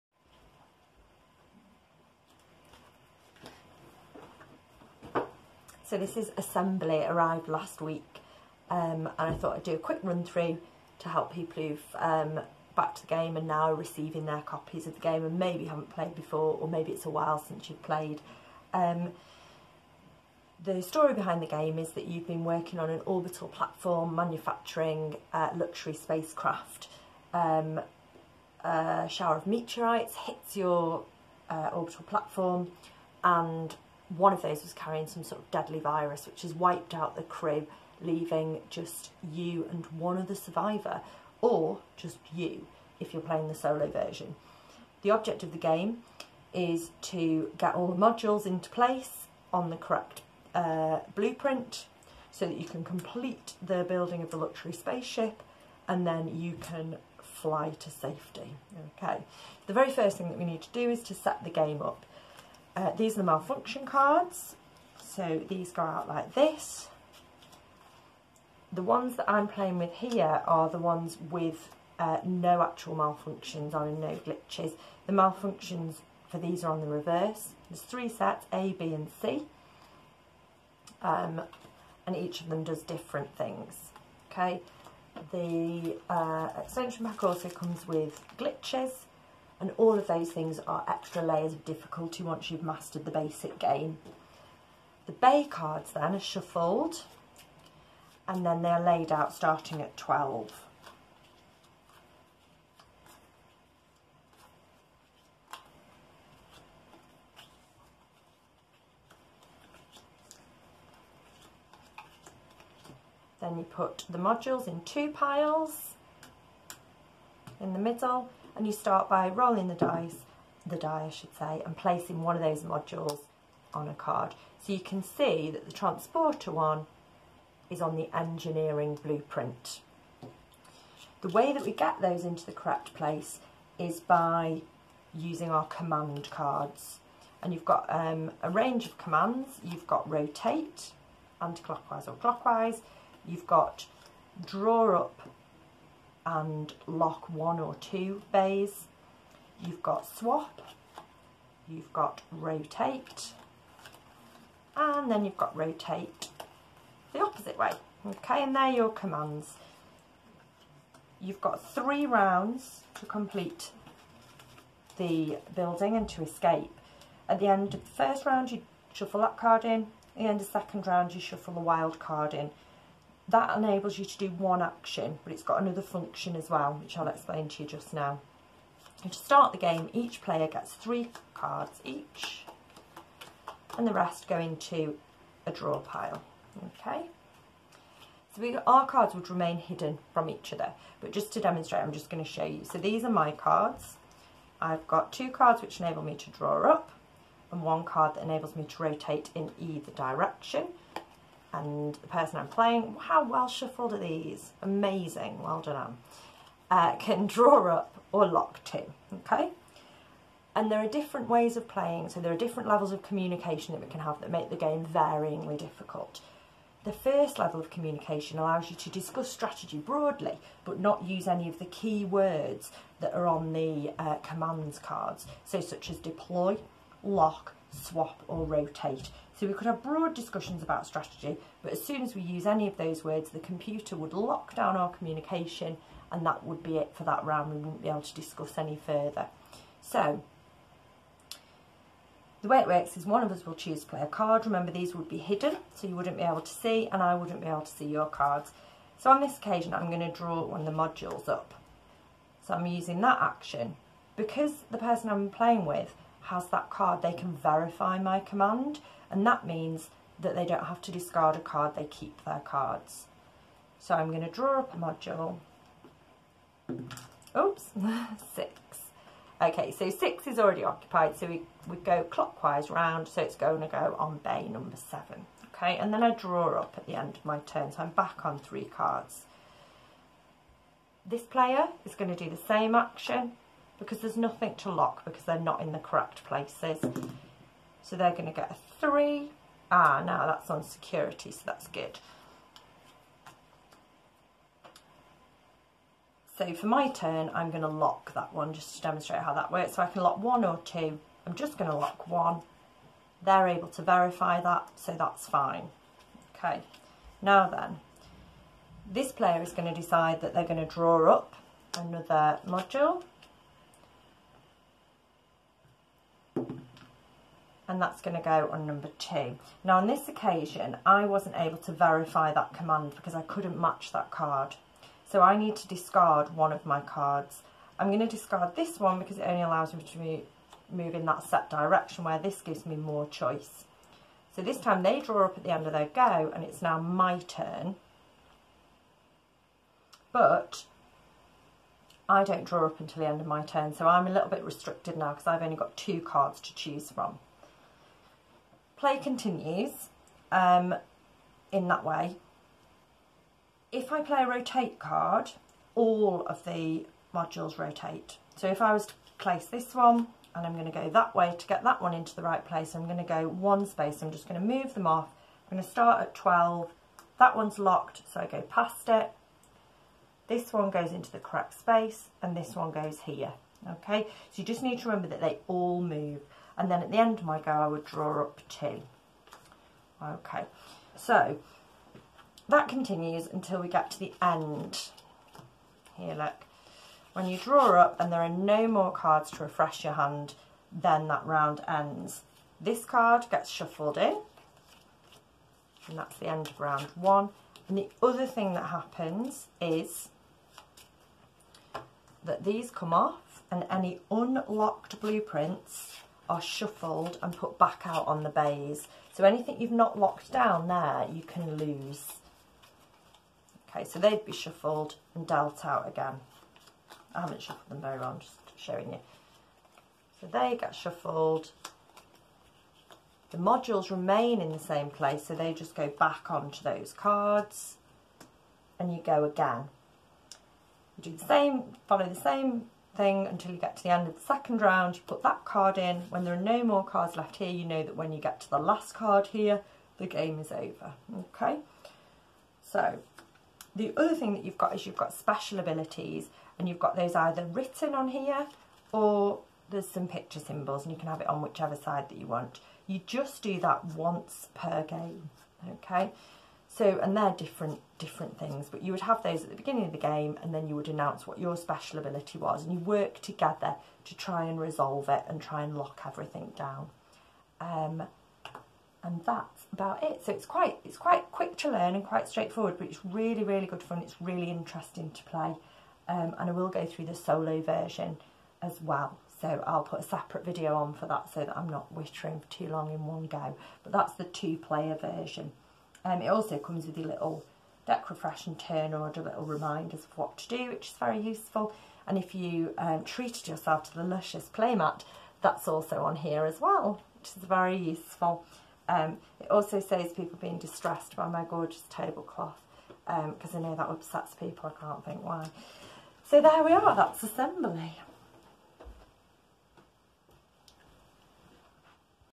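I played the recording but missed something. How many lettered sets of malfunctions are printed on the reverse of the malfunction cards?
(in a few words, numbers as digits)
3.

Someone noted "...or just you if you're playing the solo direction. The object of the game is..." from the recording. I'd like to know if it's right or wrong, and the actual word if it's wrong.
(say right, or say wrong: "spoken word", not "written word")
wrong: "version", not "direction".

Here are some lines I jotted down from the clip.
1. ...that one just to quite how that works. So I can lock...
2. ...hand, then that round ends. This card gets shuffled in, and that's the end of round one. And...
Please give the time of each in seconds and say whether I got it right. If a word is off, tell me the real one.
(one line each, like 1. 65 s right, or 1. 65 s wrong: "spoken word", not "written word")
1. 298 s wrong: "demonstrate", not "quite"
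2. 389 s right.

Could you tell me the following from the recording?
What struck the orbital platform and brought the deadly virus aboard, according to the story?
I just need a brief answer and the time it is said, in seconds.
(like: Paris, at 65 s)
a shower of meteorites, at 29 s.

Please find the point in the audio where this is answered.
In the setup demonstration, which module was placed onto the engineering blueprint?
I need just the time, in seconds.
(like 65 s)
125 s.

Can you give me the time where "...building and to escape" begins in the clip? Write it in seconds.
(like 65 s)
165 s.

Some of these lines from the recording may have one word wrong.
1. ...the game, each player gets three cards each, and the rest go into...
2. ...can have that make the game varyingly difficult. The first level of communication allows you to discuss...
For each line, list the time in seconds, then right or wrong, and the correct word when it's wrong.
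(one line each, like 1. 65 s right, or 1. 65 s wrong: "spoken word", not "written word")
1. 179 s right
2. 213 s right.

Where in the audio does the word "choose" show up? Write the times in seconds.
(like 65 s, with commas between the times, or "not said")
243 s, 346 s.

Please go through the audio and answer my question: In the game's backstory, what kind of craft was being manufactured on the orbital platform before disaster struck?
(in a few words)
luxury spacecraft.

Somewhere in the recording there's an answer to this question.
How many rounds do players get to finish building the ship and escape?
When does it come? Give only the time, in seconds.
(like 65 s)
161 s.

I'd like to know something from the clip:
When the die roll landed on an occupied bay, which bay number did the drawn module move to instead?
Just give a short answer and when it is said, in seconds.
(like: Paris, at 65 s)
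7, at 274 s.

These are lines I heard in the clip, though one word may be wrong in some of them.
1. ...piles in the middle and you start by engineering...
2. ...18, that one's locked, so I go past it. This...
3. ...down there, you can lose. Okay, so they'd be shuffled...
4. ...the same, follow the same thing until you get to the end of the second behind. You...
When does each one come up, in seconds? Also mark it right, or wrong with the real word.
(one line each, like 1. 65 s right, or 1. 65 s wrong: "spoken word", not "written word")
1. 115 s wrong: "rolling", not "engineering"
2. 366 s wrong: "12", not "18"
3. 410 s right
4. 431 s wrong: "round", not "behind".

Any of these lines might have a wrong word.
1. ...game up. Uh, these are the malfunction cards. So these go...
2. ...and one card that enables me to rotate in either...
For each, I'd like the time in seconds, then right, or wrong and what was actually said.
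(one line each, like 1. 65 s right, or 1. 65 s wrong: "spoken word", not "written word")
1. 61 s right
2. 197 s right.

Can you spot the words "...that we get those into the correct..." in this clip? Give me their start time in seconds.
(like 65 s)
131 s.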